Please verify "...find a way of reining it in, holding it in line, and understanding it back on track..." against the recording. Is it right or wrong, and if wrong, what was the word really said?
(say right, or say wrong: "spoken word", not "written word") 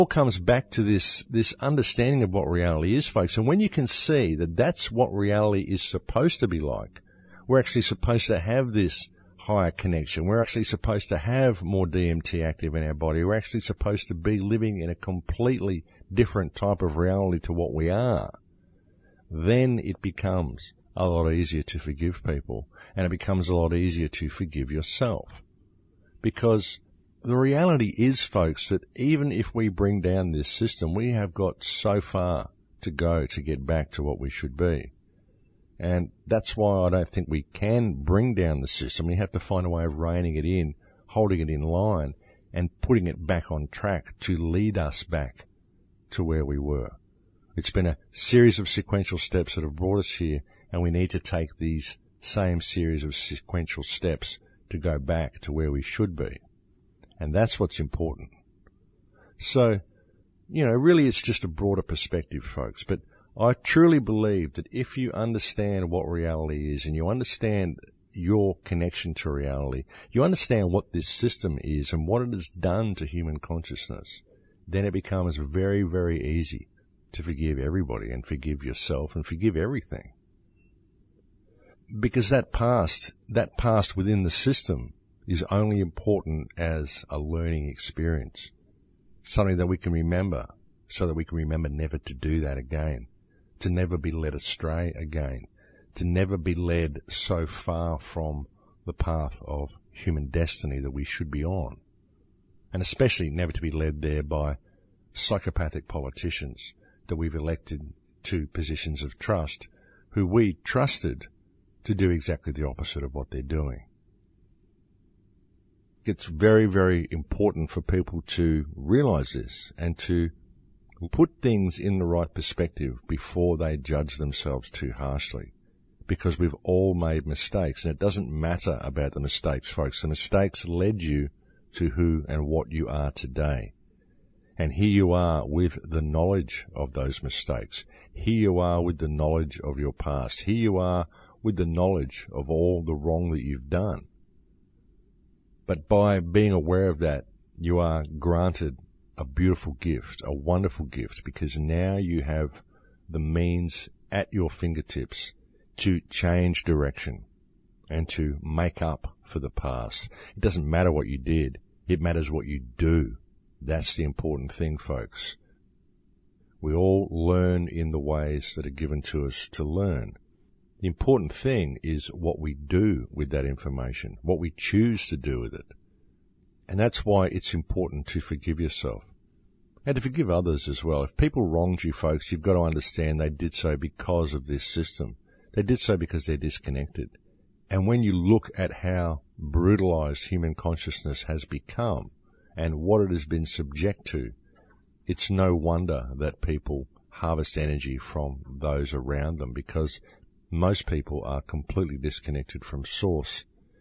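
wrong: "putting", not "understanding".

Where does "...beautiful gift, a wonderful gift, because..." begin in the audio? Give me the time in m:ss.
2:29.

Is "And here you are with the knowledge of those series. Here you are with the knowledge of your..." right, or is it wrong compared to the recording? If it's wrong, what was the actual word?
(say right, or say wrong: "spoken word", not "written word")
wrong: "mistakes", not "series".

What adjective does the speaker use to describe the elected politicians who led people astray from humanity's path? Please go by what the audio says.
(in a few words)
psychopathic.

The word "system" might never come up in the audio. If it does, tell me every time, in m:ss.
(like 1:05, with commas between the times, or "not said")
0:30, 0:38, 1:11, 1:24, 3:04.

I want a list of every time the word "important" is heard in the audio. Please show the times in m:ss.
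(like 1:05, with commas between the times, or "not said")
0:57, 1:25, 1:57, 2:44, 2:50, 2:57.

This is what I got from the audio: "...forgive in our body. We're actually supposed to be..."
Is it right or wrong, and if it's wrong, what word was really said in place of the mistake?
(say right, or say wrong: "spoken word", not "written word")
wrong: "active", not "forgive".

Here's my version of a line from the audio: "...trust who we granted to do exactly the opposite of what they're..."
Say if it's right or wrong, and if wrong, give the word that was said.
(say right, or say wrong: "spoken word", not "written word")
wrong: "trusted", not "granted".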